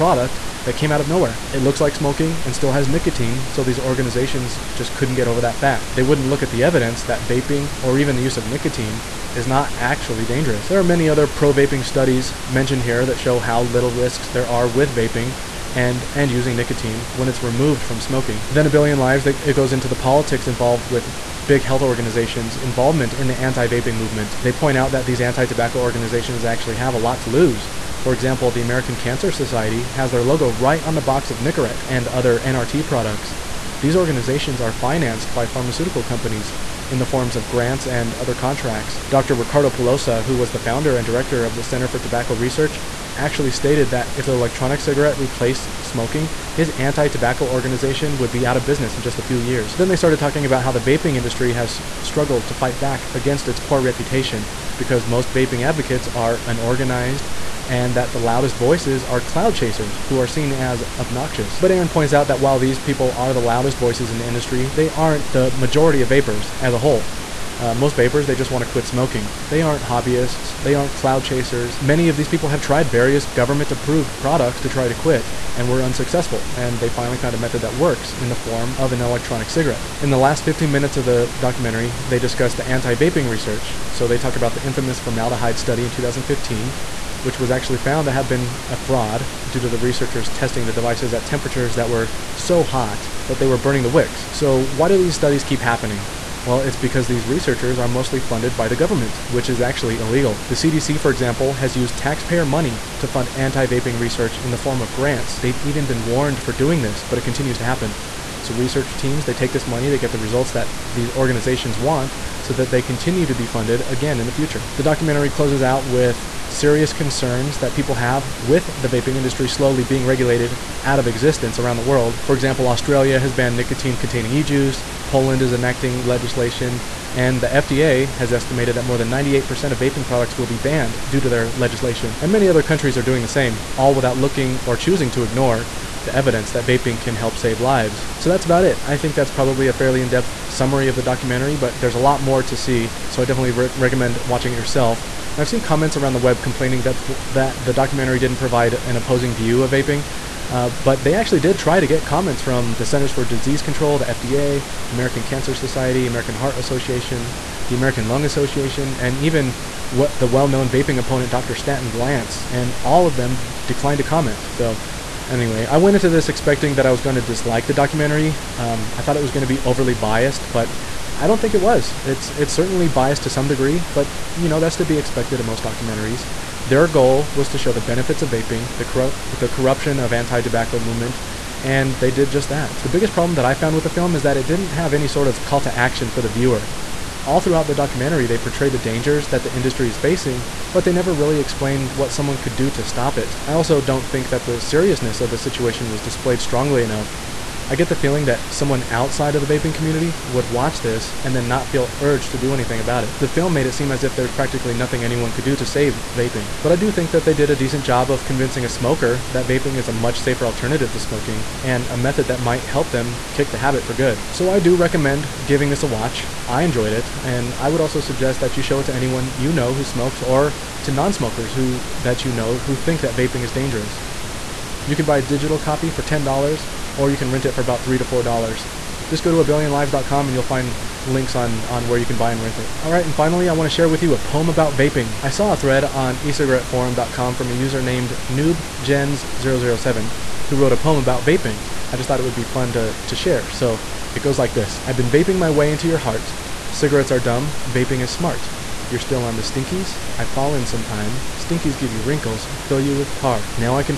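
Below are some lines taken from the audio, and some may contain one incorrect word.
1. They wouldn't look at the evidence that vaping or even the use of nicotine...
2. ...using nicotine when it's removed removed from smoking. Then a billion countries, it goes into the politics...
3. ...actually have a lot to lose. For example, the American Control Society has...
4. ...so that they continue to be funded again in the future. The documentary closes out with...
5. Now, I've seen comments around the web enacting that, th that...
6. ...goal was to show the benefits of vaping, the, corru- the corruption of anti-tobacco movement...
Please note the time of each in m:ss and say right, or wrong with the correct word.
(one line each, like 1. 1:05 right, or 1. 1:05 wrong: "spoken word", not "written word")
1. 0:05 right
2. 0:16 wrong: "lives", not "countries"
3. 0:26 wrong: "Cancer", not "Control"
4. 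1:52 right
5. 2:25 wrong: "complaining", not "enacting"
6. 2:56 right.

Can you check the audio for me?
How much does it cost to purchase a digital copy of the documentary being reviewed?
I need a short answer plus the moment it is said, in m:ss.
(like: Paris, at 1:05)
$10, at 3:46.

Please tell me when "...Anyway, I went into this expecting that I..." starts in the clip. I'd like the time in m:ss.
2:45.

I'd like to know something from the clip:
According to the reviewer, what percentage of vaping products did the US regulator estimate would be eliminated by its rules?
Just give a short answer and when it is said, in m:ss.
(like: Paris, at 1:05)
98%, at 2:09.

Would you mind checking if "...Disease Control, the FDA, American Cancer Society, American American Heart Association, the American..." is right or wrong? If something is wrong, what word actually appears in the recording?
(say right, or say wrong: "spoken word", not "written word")
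right.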